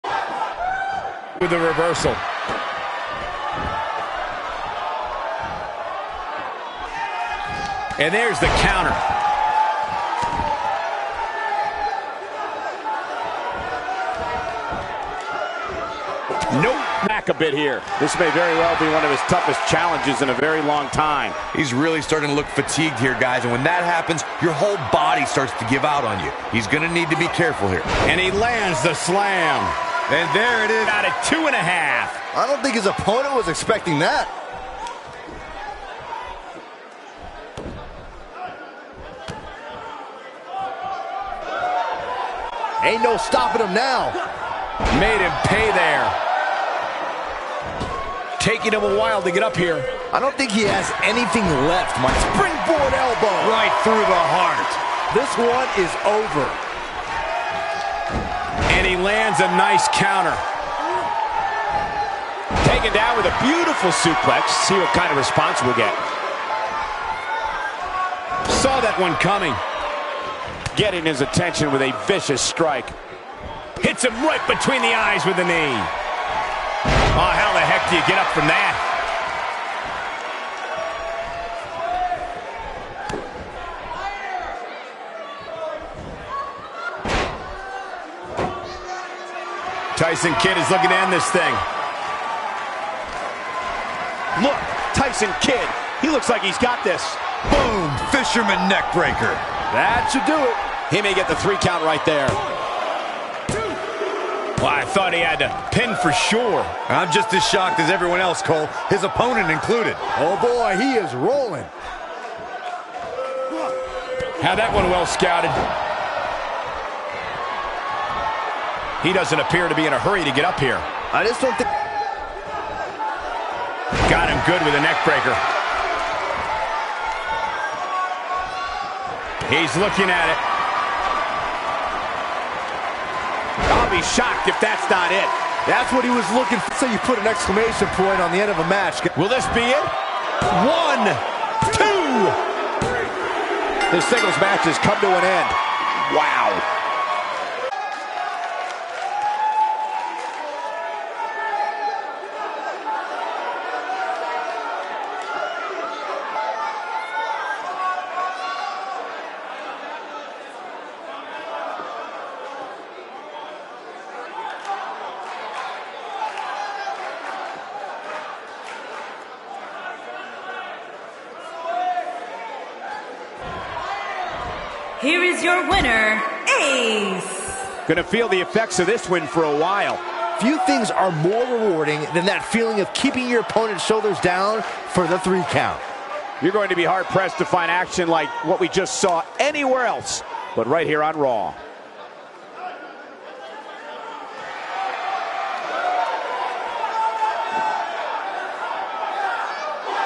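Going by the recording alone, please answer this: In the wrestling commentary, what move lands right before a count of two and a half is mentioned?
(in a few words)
The slam.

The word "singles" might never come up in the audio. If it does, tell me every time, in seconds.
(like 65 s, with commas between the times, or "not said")
144 s.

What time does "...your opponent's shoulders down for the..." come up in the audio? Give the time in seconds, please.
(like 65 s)
183 s.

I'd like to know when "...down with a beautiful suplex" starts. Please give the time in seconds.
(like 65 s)
62 s.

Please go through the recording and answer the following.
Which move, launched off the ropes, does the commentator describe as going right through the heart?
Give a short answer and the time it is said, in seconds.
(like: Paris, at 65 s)
Springboard elbow, at 52 s.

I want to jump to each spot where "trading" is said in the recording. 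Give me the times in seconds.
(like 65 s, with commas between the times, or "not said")
not said.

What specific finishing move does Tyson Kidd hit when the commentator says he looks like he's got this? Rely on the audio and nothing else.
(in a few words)
Fisherman neckbreaker.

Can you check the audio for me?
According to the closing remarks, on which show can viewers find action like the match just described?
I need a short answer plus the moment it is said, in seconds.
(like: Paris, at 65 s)
Raw, at 191 s.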